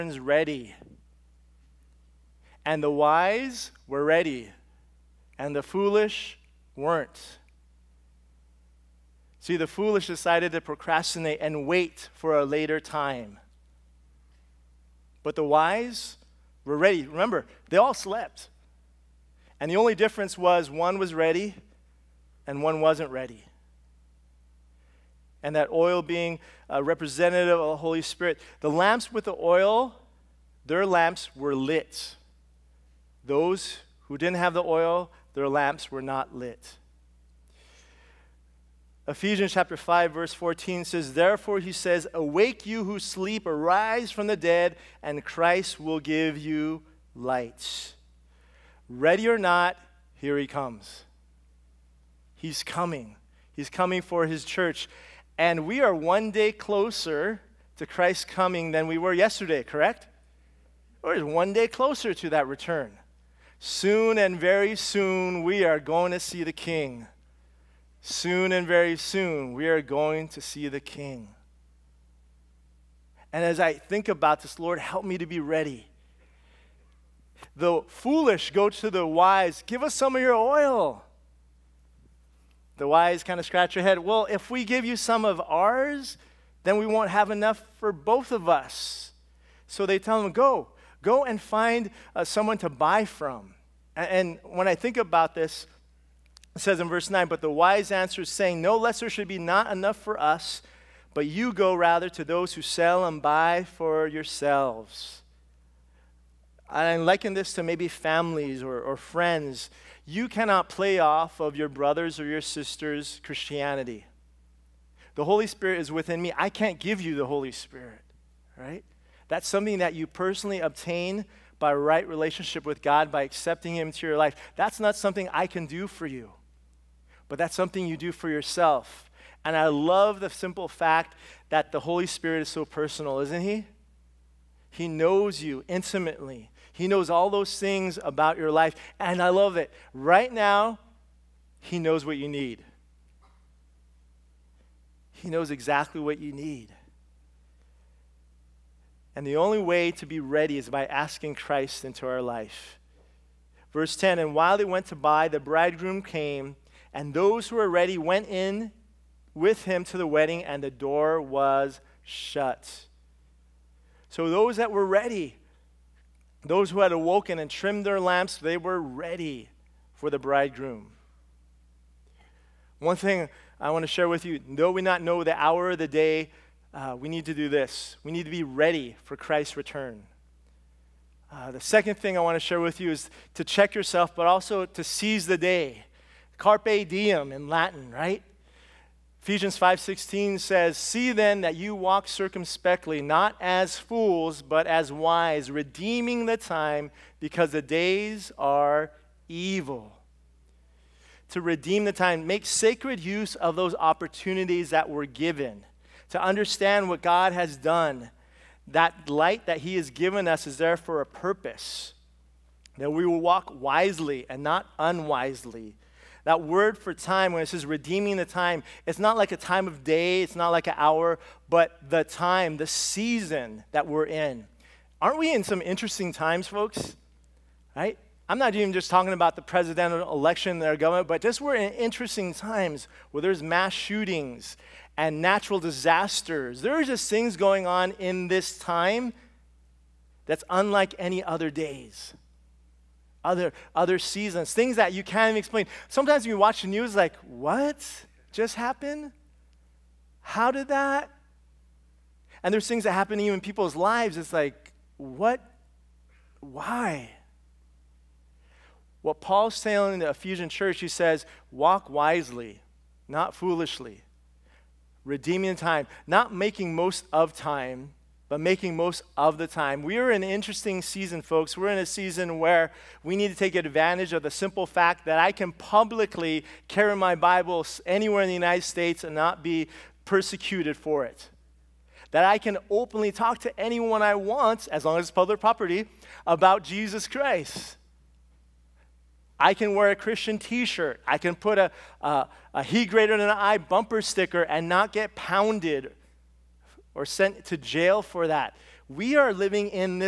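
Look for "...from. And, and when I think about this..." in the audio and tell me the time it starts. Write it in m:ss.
1:33.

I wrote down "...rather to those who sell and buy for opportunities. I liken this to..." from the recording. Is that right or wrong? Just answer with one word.
wrong.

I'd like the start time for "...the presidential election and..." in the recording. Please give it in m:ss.
3:49.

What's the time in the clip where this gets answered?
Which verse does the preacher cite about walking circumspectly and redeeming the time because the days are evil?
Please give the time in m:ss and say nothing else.
3:09.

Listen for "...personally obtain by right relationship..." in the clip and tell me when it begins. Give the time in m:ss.
2:00.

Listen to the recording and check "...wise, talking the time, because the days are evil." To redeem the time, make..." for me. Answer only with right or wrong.
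wrong.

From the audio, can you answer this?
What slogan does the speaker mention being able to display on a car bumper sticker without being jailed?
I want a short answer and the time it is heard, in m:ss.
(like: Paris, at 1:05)
He Greater Than I, at 4:52.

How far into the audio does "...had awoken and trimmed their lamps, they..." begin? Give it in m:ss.
2:46.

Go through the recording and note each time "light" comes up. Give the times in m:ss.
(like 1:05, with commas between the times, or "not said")
0:47, 3:29.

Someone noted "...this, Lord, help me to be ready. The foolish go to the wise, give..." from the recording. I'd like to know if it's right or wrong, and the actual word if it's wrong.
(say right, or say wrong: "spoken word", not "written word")
right.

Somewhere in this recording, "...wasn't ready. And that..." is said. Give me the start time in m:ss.
0:22.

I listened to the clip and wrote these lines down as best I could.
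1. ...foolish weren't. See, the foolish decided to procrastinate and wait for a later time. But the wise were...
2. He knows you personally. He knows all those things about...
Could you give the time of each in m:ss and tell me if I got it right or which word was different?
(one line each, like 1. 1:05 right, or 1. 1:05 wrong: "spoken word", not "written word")
1. 0:05 right
2. 2:14 wrong: "intimately", not "personally".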